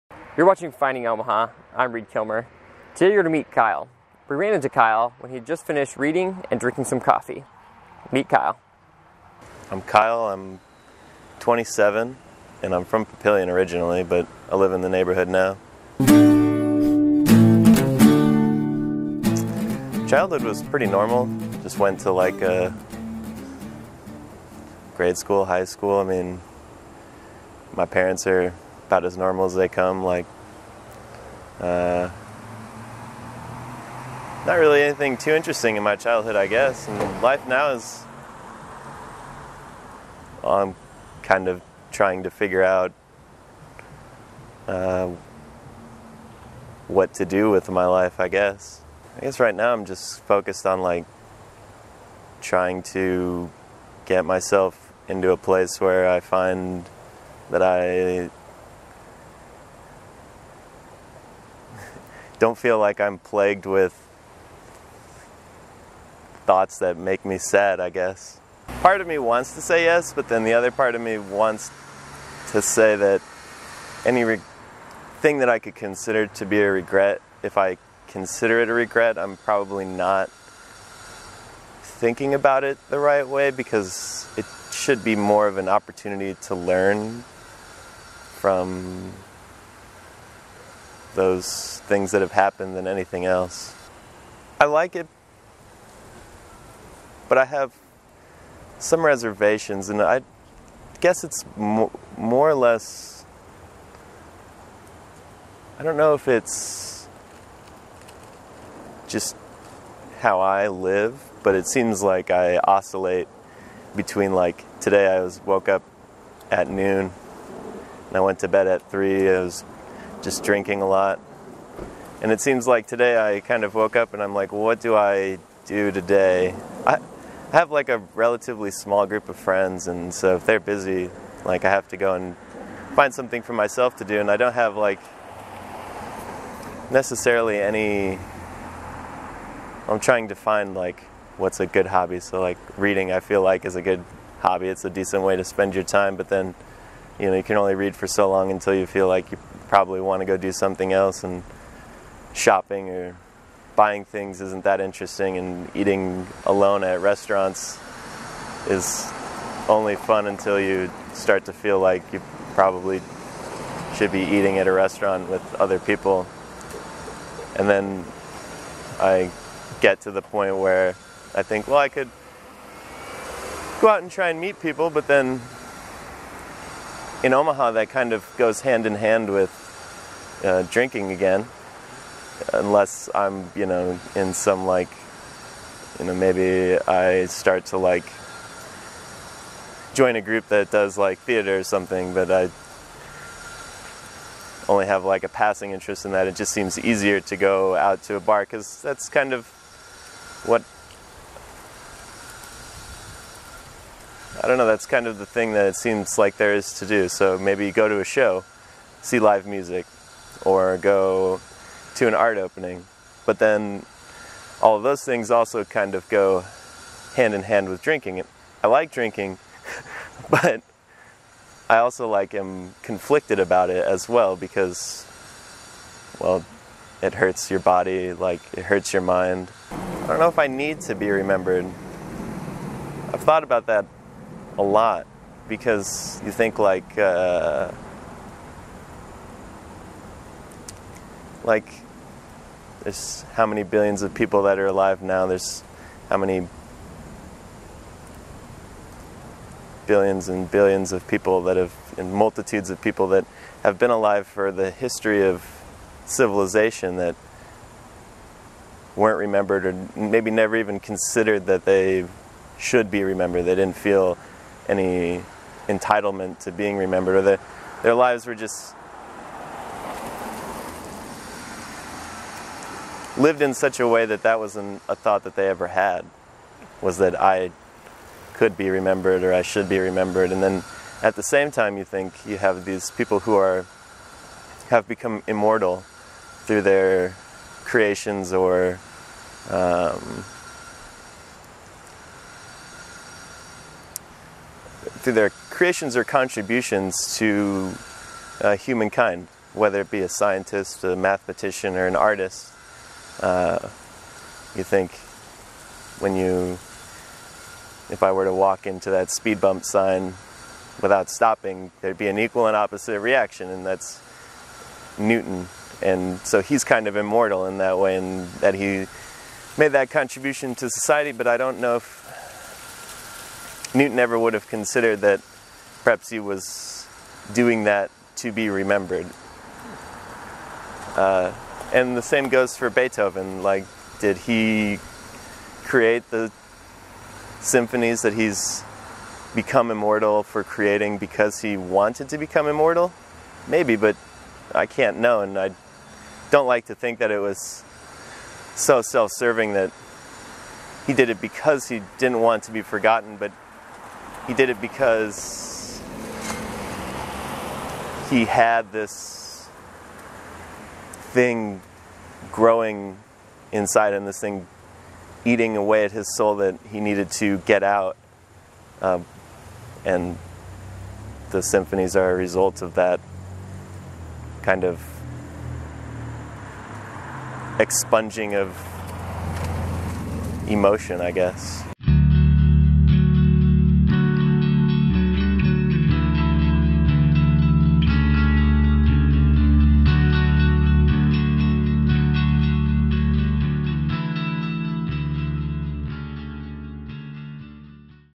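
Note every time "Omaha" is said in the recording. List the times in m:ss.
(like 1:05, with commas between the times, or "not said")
0:01, 2:57.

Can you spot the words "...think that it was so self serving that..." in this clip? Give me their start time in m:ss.
5:46.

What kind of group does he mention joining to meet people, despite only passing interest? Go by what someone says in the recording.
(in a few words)
Theater.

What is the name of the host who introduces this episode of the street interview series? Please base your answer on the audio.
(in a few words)
Reid Kilmer.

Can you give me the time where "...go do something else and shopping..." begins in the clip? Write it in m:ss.
2:30.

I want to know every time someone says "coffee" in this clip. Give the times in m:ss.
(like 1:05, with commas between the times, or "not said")
0:06.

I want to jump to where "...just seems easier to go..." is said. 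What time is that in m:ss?
3:16.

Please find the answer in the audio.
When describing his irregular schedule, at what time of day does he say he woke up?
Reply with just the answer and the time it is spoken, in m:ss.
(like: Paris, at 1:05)
Noon, at 1:56.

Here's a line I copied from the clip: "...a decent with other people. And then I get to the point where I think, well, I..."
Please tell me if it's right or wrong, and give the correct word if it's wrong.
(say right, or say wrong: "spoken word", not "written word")
wrong: "restaurant", not "decent".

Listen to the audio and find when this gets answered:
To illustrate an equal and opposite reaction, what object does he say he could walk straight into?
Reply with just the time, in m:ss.
5:09.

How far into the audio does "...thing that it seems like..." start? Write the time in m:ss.
3:25.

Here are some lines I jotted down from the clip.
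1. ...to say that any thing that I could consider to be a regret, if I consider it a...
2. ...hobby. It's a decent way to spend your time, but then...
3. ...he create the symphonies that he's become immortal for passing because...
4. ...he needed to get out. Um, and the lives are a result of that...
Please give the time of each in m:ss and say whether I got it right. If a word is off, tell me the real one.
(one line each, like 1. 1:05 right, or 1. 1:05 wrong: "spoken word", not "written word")
1. 1:12 right
2. 2:24 right
3. 5:34 wrong: "creating", not "passing"
4. 6:06 wrong: "symphonies", not "lives".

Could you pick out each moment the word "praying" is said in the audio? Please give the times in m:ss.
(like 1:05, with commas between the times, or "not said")
not said.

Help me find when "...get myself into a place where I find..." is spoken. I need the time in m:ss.
0:54.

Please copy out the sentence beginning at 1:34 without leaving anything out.
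I like it, but I have some reservations, and I guess it's more or less.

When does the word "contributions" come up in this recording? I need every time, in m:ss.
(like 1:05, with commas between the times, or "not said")
4:56, 5:19.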